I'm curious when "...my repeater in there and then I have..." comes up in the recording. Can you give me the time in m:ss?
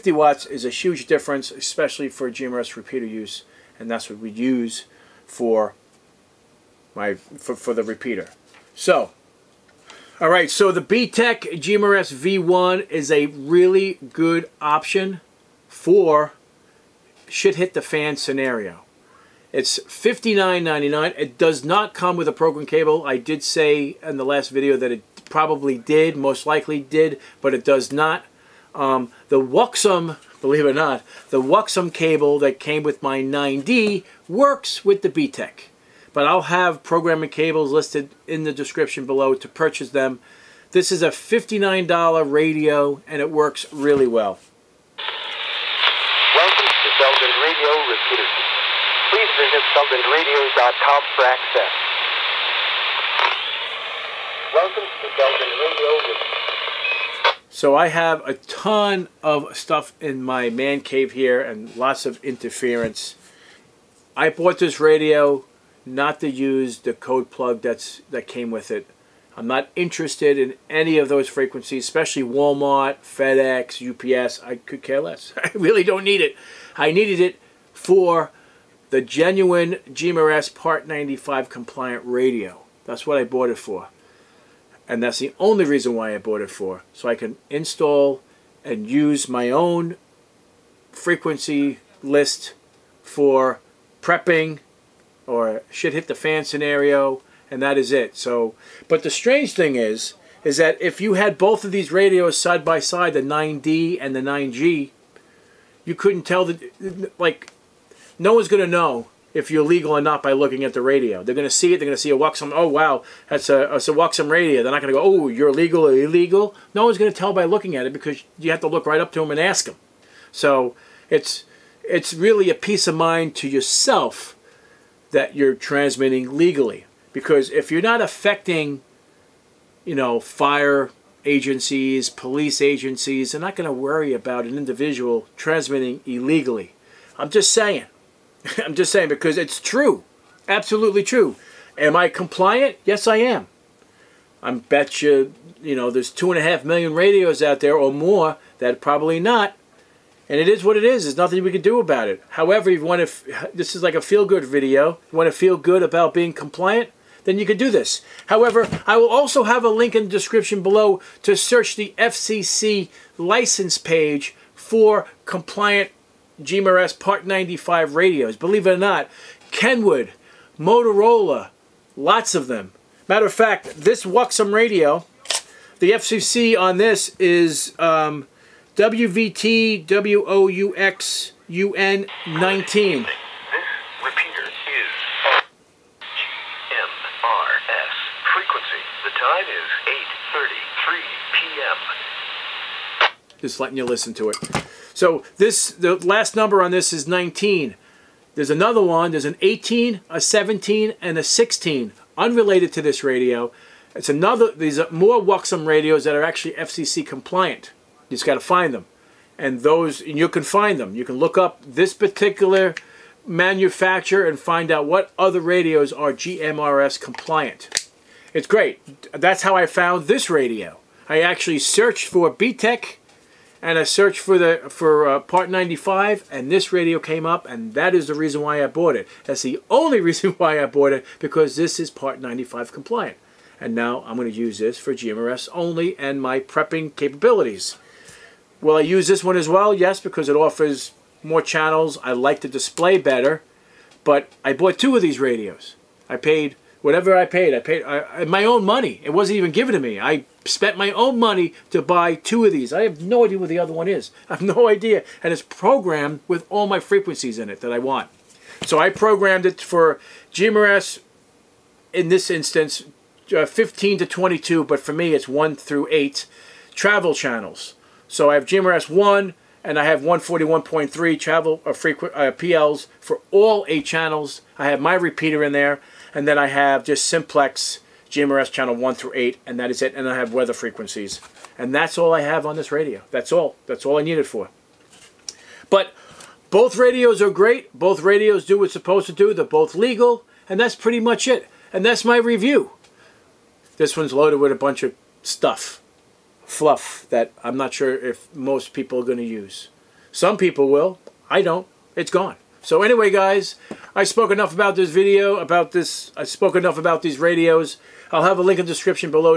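4:34.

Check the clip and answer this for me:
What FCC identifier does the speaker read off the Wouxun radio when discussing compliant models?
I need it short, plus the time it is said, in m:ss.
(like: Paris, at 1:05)
WVT 19, at 2:58.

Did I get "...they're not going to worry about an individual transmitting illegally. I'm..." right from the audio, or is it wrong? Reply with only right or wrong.
right.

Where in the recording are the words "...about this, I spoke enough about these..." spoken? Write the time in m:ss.
5:05.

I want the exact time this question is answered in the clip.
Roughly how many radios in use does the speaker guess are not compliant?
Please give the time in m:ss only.
2:26.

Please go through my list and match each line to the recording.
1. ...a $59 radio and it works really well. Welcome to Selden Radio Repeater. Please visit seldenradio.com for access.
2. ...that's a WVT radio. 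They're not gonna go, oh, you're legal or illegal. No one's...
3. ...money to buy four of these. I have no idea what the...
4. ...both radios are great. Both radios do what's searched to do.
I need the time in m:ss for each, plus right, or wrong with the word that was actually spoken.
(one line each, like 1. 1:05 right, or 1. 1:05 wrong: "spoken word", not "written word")
1. 0:41 right
2. 1:53 wrong: "Waxum", not "WVT"
3. 4:11 wrong: "two", not "four"
4. 4:46 wrong: "supposed", not "searched".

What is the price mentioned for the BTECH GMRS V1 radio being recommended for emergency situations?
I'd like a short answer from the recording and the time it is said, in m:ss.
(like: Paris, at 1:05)
$59.99, at 0:19.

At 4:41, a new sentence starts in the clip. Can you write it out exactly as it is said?
And that's all I have on this radio.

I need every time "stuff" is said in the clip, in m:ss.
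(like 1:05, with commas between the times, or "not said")
0:59, 4:55.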